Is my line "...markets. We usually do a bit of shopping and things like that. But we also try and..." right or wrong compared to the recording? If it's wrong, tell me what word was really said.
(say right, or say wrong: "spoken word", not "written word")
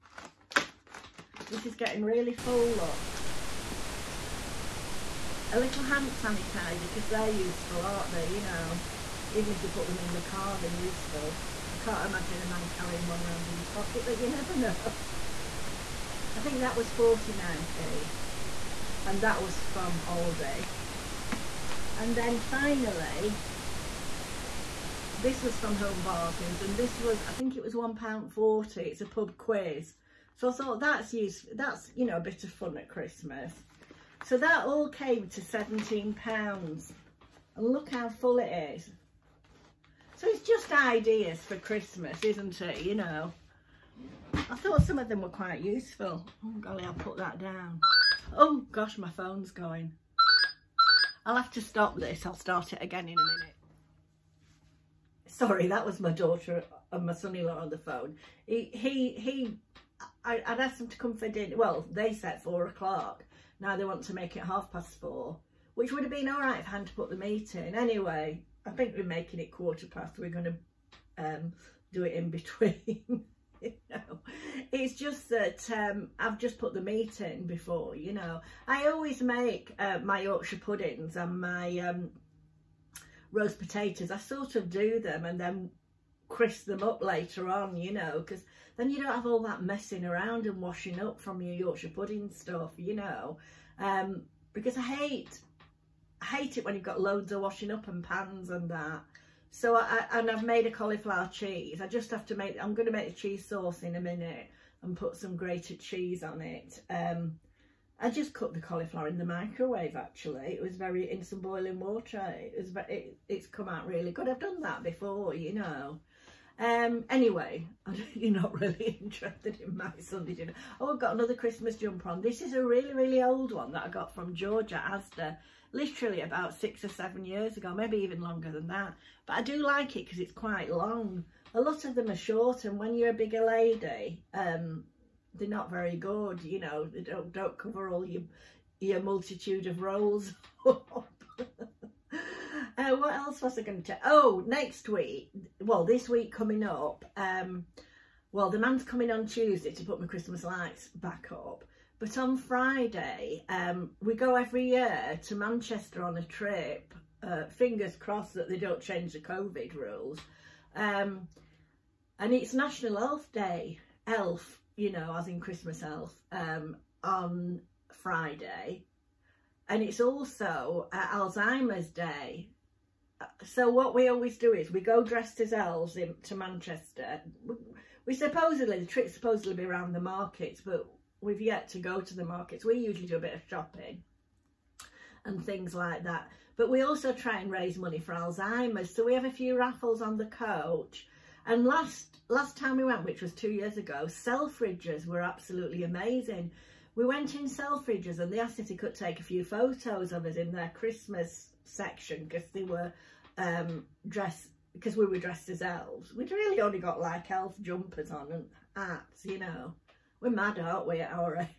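right.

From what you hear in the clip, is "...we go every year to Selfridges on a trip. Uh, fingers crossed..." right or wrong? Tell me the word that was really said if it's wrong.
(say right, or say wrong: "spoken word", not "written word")
wrong: "Manchester", not "Selfridges".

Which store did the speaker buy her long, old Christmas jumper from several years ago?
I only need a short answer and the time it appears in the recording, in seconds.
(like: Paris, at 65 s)
George at Asda, at 124 s.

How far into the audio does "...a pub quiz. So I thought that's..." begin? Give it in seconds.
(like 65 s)
28 s.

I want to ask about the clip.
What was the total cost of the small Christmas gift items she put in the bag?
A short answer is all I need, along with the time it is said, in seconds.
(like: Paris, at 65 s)
£17, at 35 s.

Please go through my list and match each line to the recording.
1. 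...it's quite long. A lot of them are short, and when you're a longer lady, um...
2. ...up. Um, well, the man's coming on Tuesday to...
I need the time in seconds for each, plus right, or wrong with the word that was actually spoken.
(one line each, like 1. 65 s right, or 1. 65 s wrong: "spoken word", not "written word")
1. 130 s wrong: "bigger", not "longer"
2. 146 s right.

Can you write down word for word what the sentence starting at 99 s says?
So I, and I've made a cauliflower cheese.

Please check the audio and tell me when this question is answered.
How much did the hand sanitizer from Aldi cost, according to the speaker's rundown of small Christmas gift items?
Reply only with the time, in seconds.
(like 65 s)
16 s.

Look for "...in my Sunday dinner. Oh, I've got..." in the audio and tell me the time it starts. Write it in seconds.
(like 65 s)
119 s.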